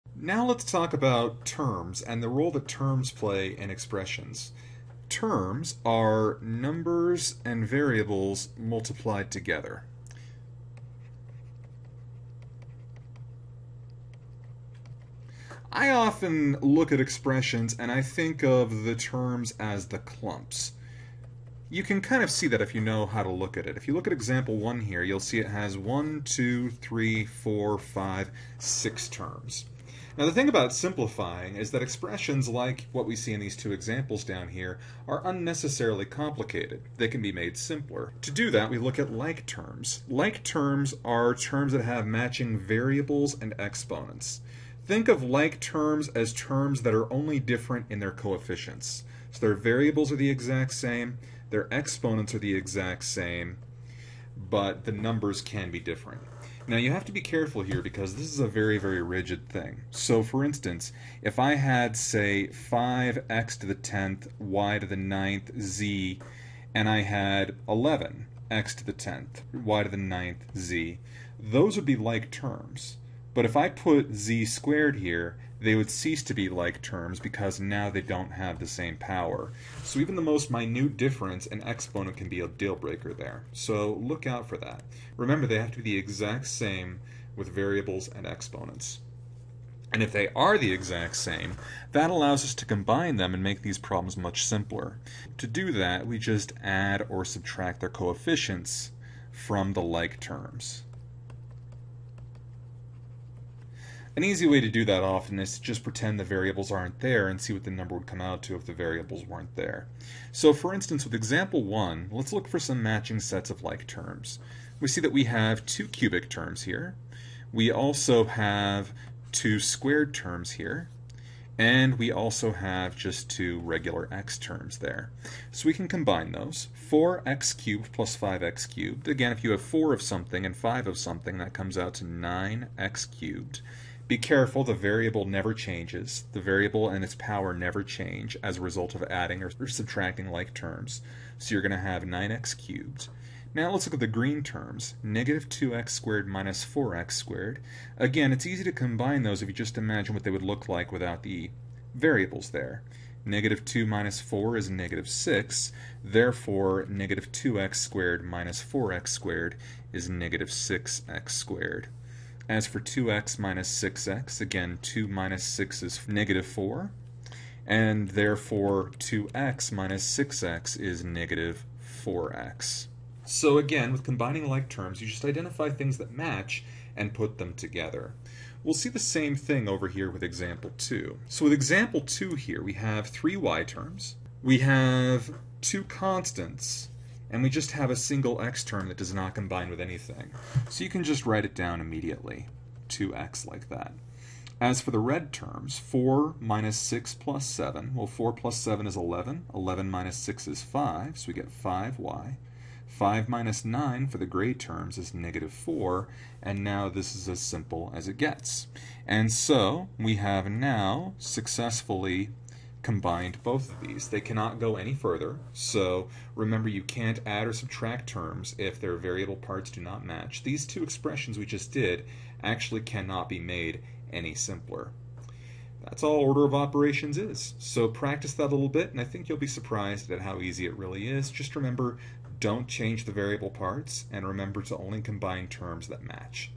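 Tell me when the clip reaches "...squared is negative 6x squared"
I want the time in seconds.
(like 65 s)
159 s.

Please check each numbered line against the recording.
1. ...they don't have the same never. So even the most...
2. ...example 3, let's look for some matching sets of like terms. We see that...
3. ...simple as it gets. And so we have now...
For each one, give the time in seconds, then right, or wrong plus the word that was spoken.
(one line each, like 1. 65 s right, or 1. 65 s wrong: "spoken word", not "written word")
1. 77 s wrong: "power", not "never"
2. 111 s wrong: "1", not "3"
3. 207 s right.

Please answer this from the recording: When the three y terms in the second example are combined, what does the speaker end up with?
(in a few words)
5y.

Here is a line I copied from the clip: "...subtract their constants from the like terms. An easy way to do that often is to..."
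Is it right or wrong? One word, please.
wrong.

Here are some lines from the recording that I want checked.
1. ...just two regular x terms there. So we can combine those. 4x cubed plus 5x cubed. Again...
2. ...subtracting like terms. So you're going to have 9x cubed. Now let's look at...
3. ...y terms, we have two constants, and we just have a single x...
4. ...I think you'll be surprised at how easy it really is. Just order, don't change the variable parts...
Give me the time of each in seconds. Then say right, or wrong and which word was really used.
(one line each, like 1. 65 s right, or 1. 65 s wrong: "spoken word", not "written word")
1. 122 s right
2. 139 s right
3. 183 s right
4. 229 s wrong: "remember", not "order".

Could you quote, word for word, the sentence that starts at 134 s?
Be careful, the variable never changes.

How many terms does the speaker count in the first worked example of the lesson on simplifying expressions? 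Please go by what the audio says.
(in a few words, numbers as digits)
6.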